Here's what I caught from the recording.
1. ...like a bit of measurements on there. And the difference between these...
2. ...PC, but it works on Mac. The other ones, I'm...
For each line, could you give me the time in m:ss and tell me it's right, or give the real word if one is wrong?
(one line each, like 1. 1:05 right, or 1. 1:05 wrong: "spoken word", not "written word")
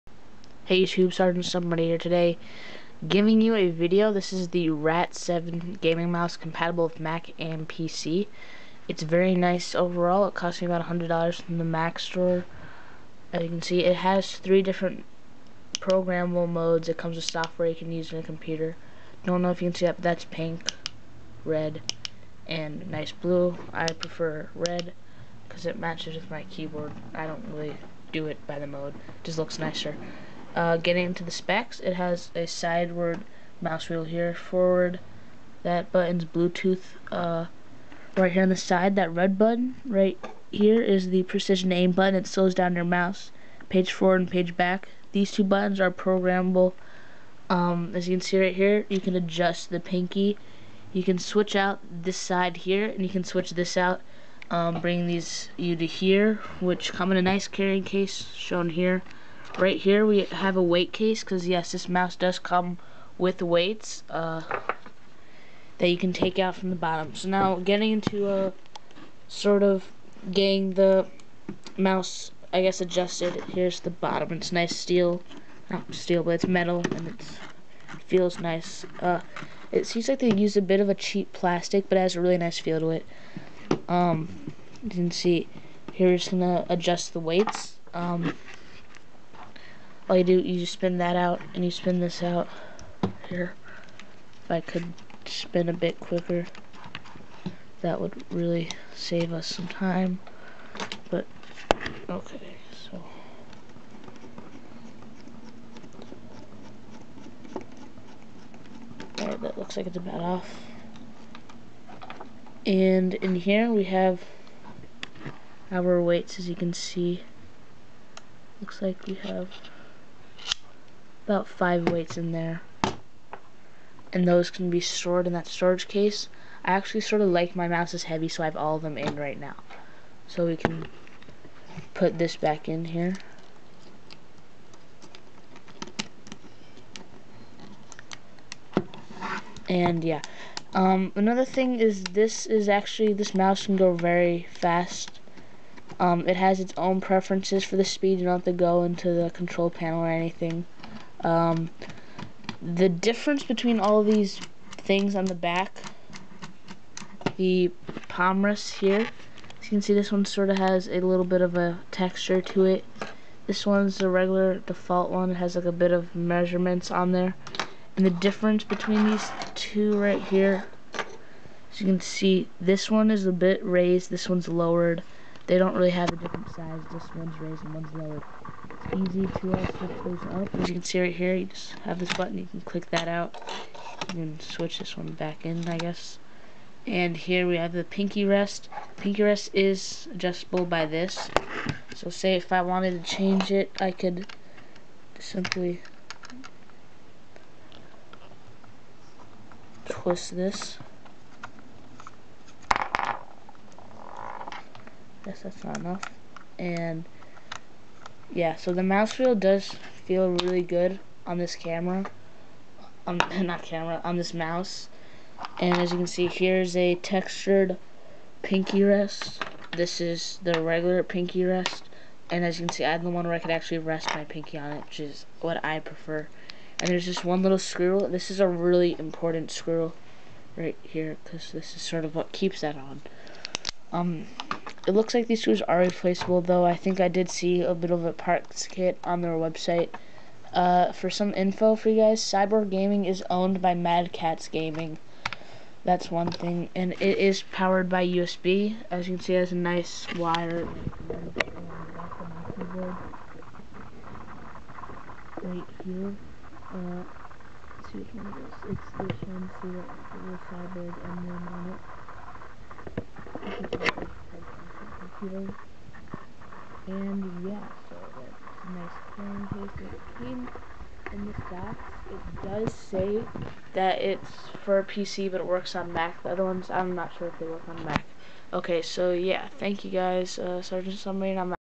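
1. 2:45 right
2. 4:34 right.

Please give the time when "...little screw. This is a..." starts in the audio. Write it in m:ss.
3:47.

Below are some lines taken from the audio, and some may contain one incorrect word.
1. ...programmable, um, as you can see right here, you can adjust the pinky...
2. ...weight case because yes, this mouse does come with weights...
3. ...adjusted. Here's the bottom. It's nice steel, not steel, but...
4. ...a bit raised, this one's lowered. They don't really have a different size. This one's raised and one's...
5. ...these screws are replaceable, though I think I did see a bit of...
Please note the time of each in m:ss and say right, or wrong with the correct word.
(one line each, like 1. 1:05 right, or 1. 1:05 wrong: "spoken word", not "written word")
1. 0:45 right
2. 1:00 right
3. 1:12 right
4. 2:53 right
5. 3:55 right.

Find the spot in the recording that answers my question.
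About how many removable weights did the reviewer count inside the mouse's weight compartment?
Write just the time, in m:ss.
2:01.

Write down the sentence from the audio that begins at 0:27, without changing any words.
I don't really do it by the mode.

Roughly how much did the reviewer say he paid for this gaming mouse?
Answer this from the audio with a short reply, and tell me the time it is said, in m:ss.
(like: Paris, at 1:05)
$100, at 0:10.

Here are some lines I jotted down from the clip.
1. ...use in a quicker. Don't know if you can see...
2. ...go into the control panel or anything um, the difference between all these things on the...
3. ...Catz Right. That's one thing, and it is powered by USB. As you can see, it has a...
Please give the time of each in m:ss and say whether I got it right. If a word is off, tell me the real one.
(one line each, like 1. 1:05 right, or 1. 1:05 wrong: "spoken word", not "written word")
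1. 0:17 wrong: "computer", not "quicker"
2. 2:28 right
3. 4:04 wrong: "Gaming", not "Right".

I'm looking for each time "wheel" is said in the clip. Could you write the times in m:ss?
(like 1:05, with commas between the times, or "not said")
0:33, 3:29.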